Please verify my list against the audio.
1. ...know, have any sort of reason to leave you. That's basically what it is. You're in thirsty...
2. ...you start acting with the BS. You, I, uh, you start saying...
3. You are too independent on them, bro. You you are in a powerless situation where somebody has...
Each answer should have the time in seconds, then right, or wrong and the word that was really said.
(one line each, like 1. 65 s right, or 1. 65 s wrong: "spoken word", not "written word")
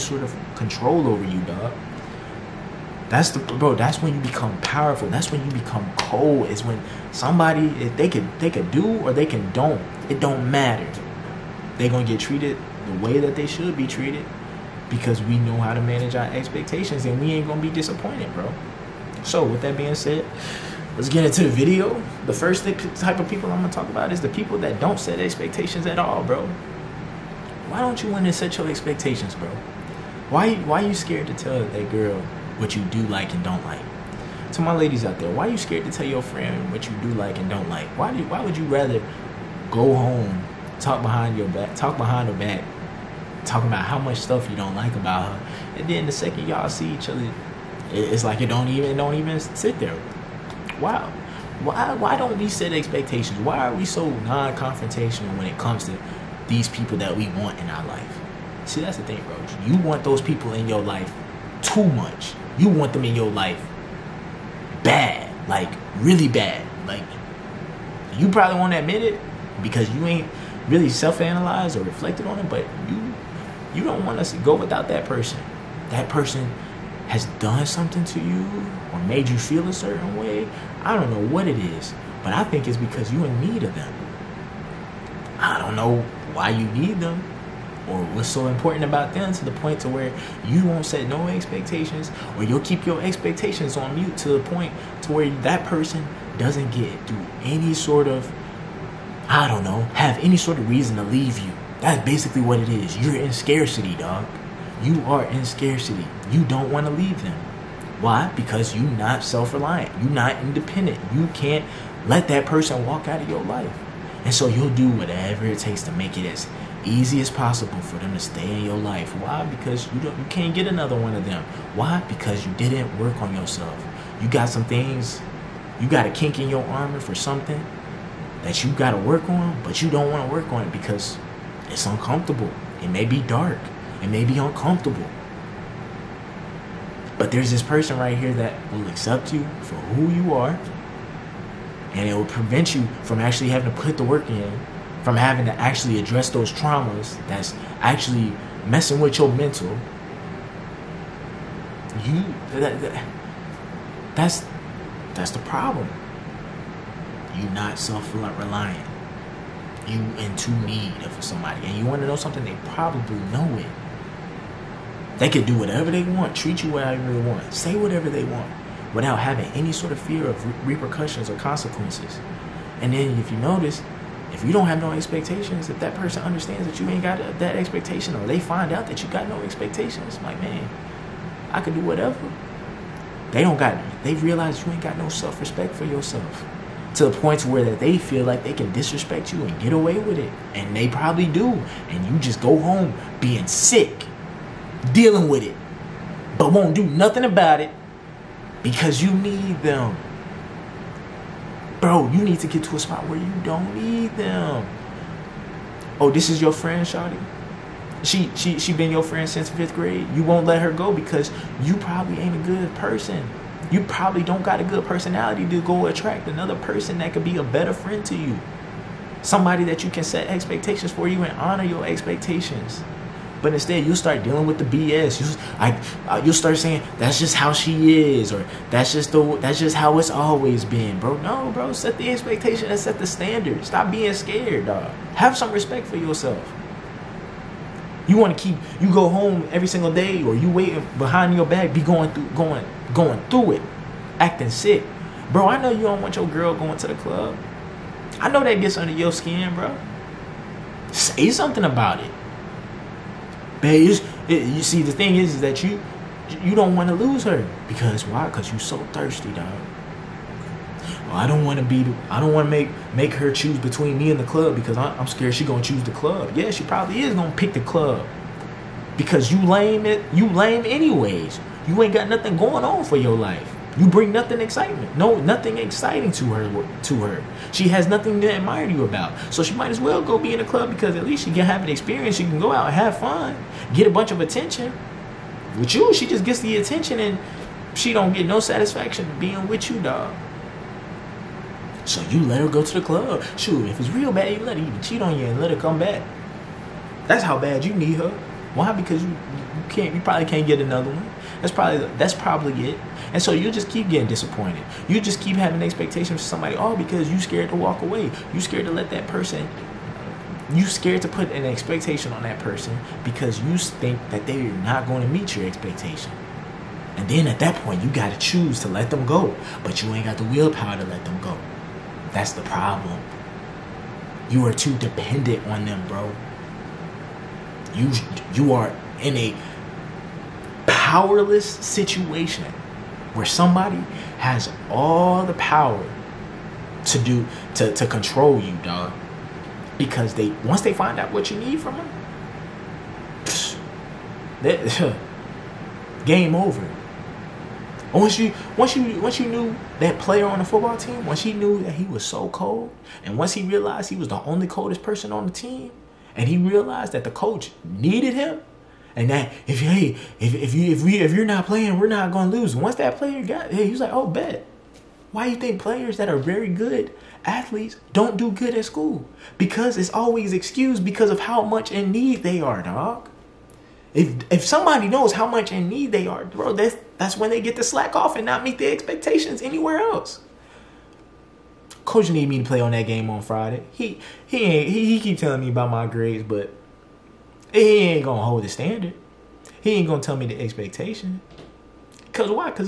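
1. 99 s wrong: "scarcity", not "thirsty"
2. 223 s wrong: "dealing", not "acting"
3. 324 s wrong: "dependent", not "independent".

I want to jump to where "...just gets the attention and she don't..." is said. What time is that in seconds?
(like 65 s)
286 s.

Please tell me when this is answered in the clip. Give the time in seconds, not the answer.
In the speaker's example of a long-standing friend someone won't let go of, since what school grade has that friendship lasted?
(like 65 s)
209 s.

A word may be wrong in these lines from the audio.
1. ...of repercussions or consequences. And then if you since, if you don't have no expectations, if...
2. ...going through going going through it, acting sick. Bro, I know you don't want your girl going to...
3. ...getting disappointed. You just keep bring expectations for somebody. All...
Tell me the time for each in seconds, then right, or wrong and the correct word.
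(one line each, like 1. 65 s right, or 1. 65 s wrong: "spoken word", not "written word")
1. 170 s wrong: "notice", not "since"
2. 241 s right
3. 303 s wrong: "having", not "bring".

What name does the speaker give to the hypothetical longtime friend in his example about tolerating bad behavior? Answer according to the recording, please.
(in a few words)
Shotty.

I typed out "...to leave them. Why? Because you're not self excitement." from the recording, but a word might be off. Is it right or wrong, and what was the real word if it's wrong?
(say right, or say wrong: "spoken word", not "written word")
wrong: "reliant", not "excitement".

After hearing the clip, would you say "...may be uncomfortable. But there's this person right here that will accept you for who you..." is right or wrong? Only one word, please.
right.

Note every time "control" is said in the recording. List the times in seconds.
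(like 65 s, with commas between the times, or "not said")
0 s, 337 s.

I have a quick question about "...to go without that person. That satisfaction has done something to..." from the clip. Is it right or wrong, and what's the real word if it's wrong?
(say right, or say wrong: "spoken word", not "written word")
wrong: "person", not "satisfaction".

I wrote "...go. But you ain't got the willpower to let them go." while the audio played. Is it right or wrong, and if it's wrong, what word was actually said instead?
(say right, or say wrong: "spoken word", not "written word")
right.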